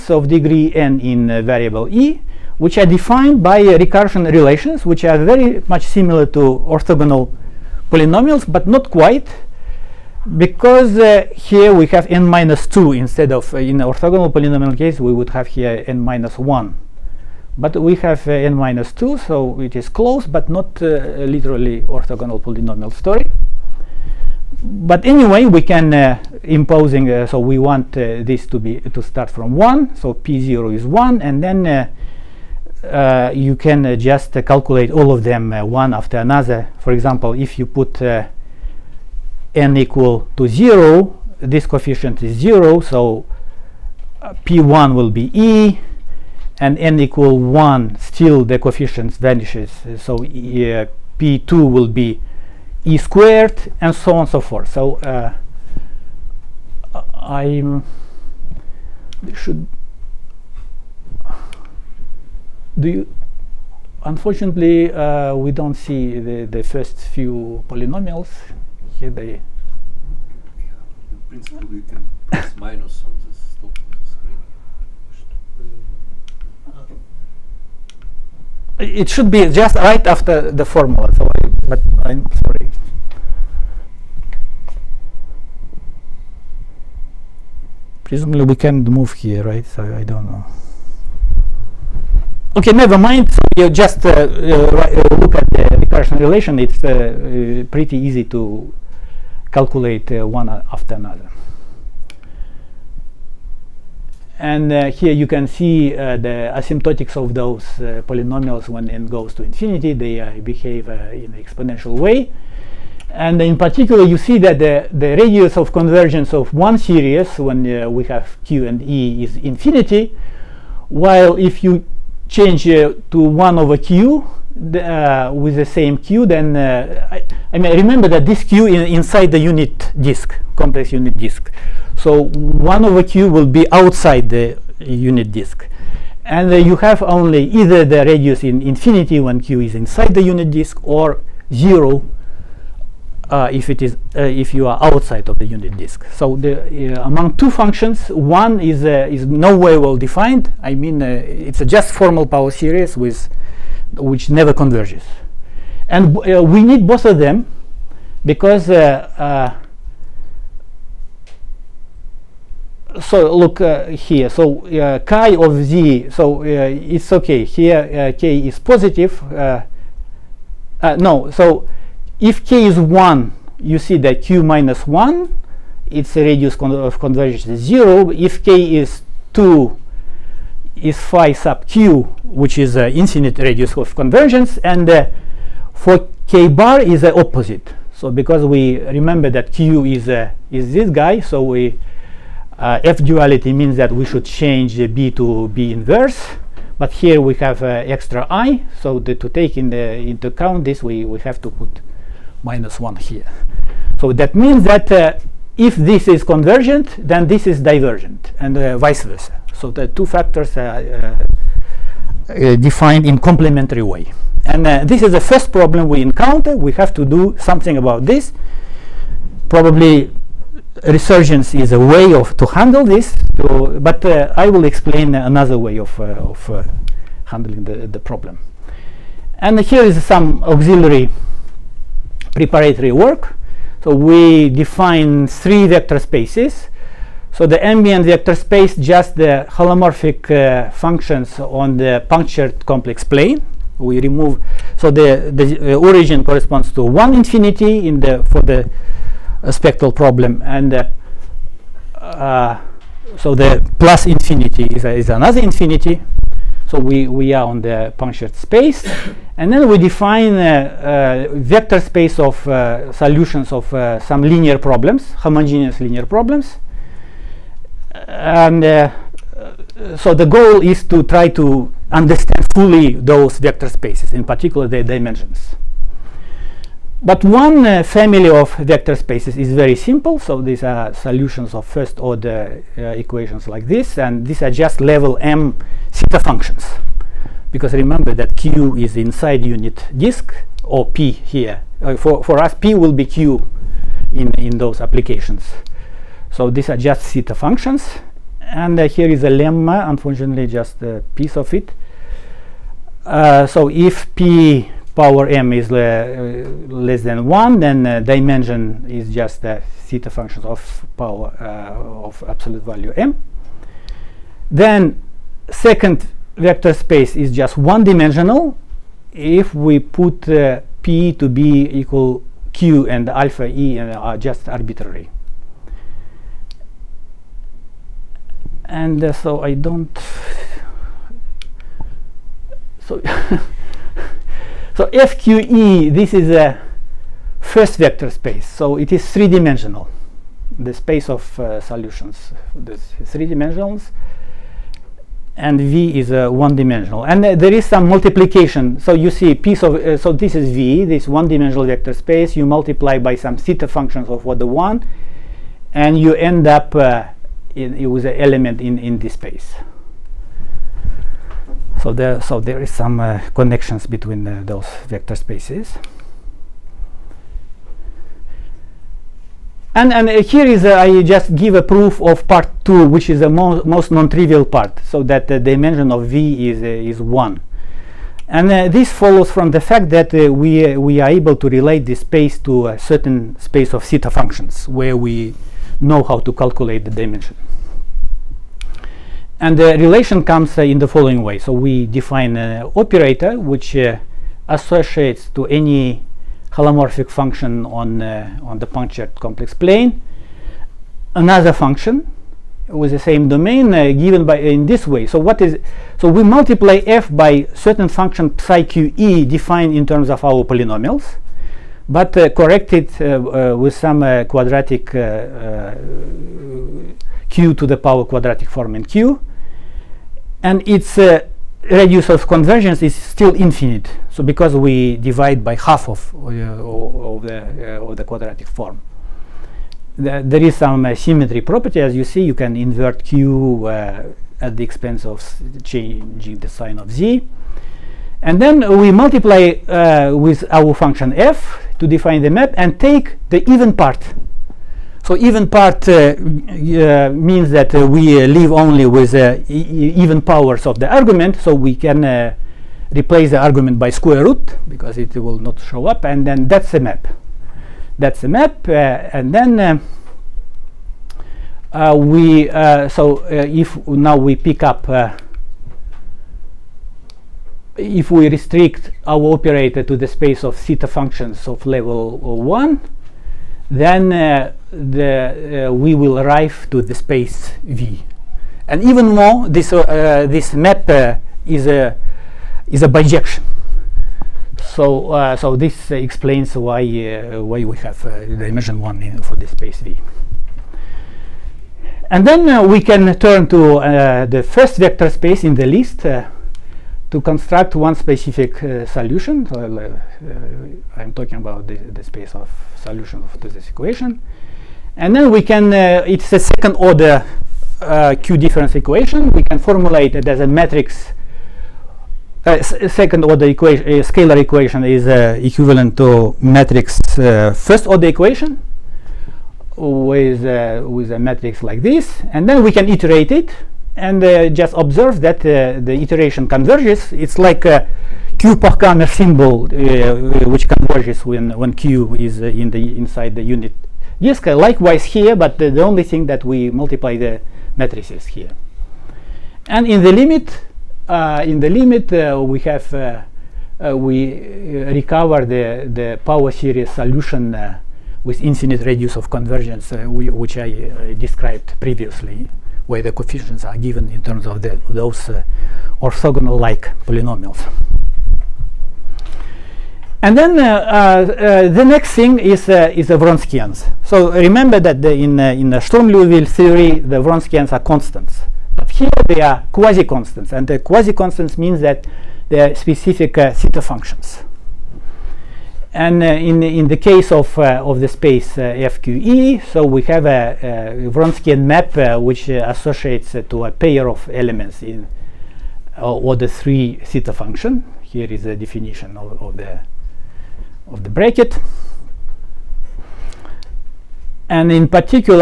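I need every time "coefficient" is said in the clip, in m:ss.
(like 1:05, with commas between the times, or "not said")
0:41, 0:48, 9:13.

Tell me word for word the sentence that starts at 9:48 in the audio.
Here is the definition of, of, the, of the bracket.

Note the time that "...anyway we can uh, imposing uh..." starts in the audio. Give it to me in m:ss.
0:25.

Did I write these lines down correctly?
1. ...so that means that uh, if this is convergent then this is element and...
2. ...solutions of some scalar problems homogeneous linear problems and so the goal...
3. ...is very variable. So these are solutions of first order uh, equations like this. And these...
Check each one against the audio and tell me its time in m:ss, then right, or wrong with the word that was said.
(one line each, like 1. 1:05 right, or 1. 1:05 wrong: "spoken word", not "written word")
1. 3:24 wrong: "divergent", not "element"
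2. 4:22 wrong: "linear", not "scalar"
3. 4:39 wrong: "simple", not "variable".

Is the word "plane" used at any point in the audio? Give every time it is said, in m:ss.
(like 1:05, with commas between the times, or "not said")
4:03, 6:39.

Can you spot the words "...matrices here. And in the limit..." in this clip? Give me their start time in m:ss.
8:57.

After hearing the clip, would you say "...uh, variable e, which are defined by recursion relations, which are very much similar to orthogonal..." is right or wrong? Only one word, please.
right.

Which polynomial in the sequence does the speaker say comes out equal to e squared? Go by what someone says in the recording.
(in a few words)
p2.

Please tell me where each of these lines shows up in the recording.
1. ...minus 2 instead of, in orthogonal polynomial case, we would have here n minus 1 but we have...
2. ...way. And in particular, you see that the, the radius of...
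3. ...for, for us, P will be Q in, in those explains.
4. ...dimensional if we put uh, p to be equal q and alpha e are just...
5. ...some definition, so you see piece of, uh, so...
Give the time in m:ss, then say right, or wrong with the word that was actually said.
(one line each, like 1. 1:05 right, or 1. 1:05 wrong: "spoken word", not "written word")
1. 0:12 right
2. 1:51 right
3. 4:51 wrong: "applications", not "explains"
4. 5:17 right
5. 5:47 wrong: "multiplication", not "definition".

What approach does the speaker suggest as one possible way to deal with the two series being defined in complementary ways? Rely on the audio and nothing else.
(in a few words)
resurgence.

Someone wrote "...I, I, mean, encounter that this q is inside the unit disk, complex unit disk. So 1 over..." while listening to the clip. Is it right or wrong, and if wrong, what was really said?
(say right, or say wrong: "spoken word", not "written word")
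wrong: "remember", not "encounter".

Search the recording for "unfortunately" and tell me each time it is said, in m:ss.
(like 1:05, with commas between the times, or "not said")
1:04, 4:59.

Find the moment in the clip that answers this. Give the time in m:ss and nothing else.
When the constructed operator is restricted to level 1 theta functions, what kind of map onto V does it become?
8:02.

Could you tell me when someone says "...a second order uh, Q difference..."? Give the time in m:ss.
8:26.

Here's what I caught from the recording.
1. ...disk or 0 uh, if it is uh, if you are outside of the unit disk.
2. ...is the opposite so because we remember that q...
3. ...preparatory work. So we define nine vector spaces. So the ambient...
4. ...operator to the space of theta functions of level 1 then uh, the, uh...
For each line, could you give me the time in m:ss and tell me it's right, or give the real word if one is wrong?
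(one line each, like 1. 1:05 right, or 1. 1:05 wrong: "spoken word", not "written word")
1. 2:20 right
2. 3:06 right
3. 3:52 wrong: "three", not "nine"
4. 7:49 right.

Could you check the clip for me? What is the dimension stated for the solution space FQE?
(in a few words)
3.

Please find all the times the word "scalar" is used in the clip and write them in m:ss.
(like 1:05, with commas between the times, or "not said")
8:34.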